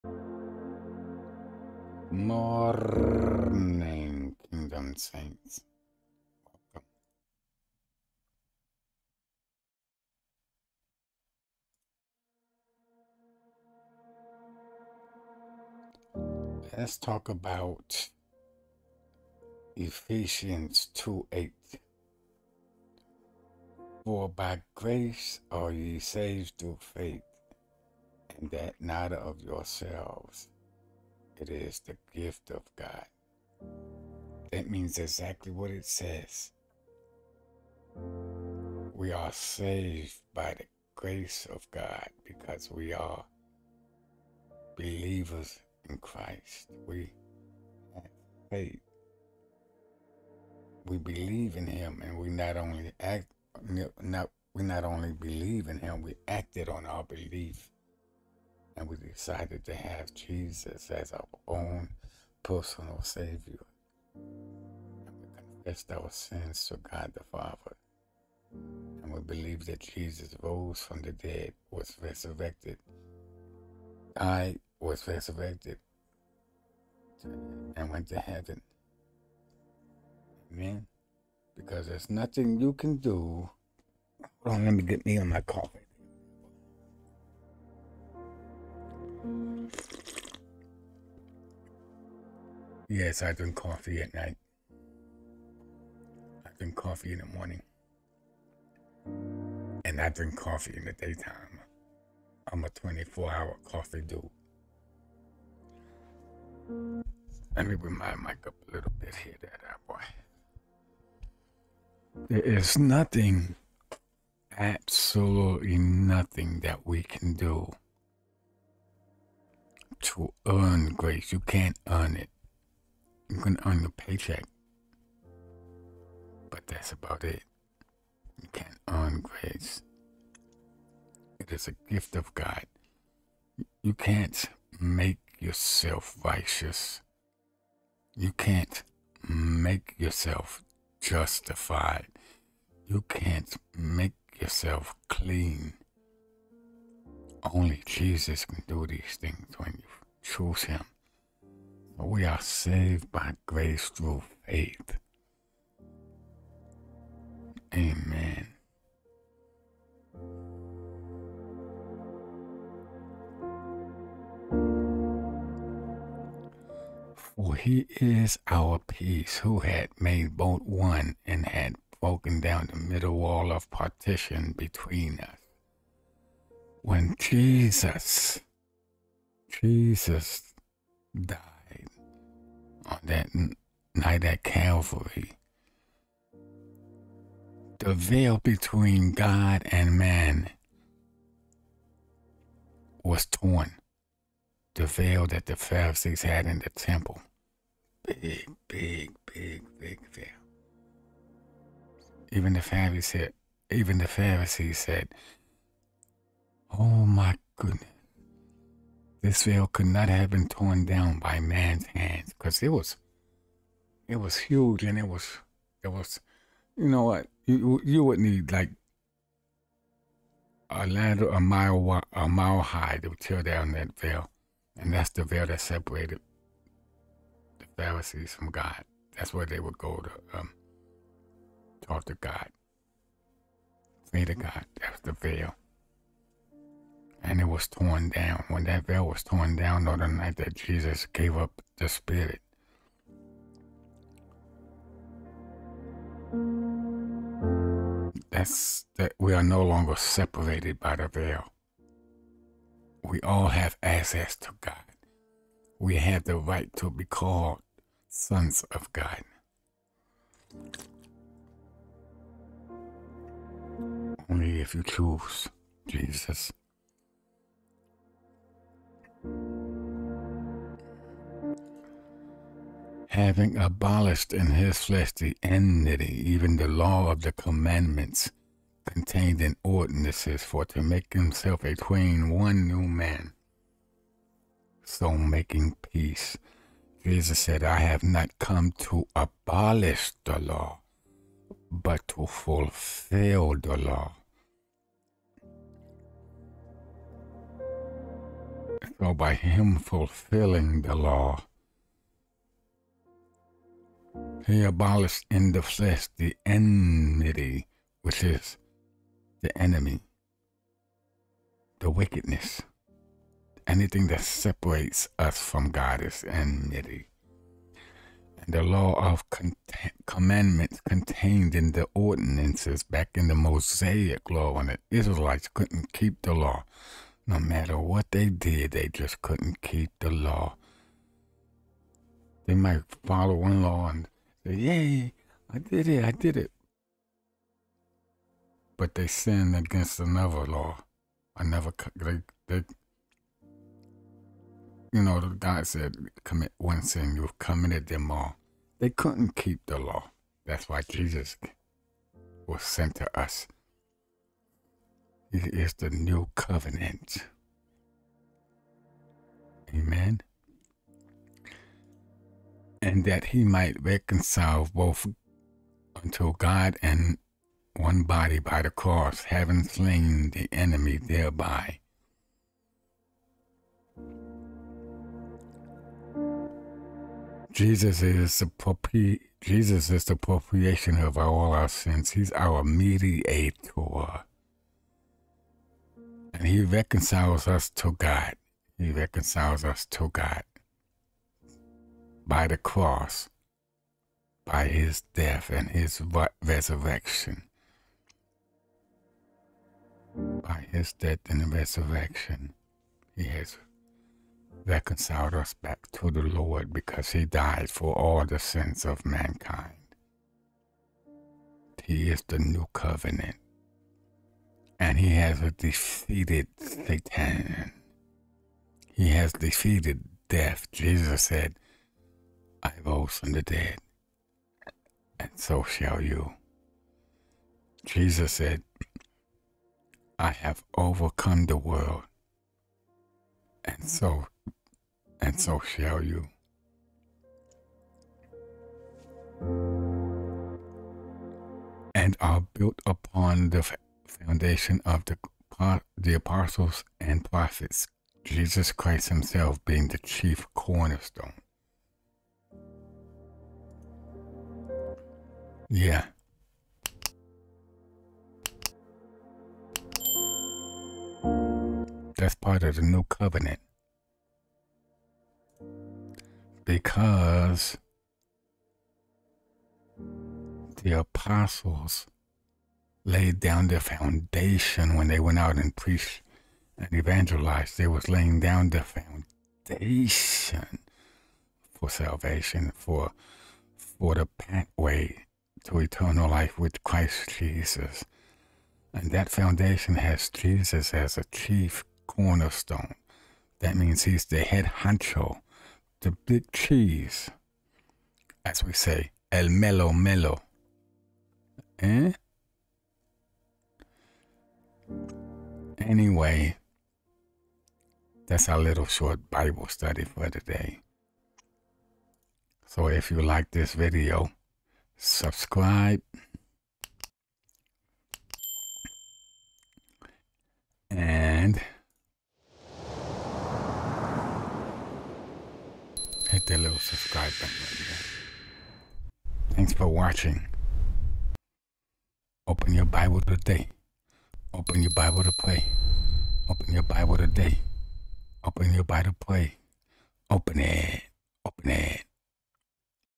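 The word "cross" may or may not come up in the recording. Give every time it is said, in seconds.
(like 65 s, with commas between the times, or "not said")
368 s, 392 s.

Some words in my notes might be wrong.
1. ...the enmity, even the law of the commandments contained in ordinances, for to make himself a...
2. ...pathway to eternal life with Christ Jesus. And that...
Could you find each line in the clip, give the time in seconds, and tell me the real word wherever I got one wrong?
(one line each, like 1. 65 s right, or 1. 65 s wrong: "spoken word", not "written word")
1. 275 s right
2. 484 s right.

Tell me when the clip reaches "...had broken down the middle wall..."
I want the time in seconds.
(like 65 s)
171 s.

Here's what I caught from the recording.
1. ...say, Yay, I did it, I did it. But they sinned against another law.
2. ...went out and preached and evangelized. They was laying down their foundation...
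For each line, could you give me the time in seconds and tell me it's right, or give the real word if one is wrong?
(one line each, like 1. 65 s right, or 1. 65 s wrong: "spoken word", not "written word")
1. 334 s right
2. 475 s right.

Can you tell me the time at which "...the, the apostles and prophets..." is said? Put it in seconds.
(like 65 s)
445 s.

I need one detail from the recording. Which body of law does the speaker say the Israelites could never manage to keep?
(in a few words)
Mosaic law.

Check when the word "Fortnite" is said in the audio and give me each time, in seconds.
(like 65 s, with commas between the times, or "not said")
not said.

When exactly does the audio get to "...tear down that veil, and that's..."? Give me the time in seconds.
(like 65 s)
223 s.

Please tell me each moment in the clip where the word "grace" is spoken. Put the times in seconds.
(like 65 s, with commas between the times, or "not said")
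24 s, 40 s, 120 s, 129 s, 153 s.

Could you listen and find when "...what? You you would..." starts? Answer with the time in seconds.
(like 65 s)
217 s.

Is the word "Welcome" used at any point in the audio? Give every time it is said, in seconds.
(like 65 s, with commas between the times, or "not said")
13 s.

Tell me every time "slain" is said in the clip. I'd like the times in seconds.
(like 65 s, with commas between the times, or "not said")
369 s.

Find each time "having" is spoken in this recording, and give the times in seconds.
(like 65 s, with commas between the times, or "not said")
273 s, 369 s.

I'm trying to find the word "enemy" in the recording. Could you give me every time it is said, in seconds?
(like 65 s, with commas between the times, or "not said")
309 s, 370 s.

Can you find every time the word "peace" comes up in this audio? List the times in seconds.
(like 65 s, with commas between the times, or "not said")
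168 s, 285 s.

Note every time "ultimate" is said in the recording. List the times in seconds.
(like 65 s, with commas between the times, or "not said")
not said.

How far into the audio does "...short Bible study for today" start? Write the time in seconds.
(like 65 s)
508 s.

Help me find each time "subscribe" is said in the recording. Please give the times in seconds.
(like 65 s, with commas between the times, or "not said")
514 s, 526 s.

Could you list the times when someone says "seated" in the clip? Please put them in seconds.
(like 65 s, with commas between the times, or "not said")
not said.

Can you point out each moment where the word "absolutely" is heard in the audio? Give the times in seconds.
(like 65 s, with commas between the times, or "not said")
114 s.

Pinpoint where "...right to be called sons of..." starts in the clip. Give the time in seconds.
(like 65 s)
256 s.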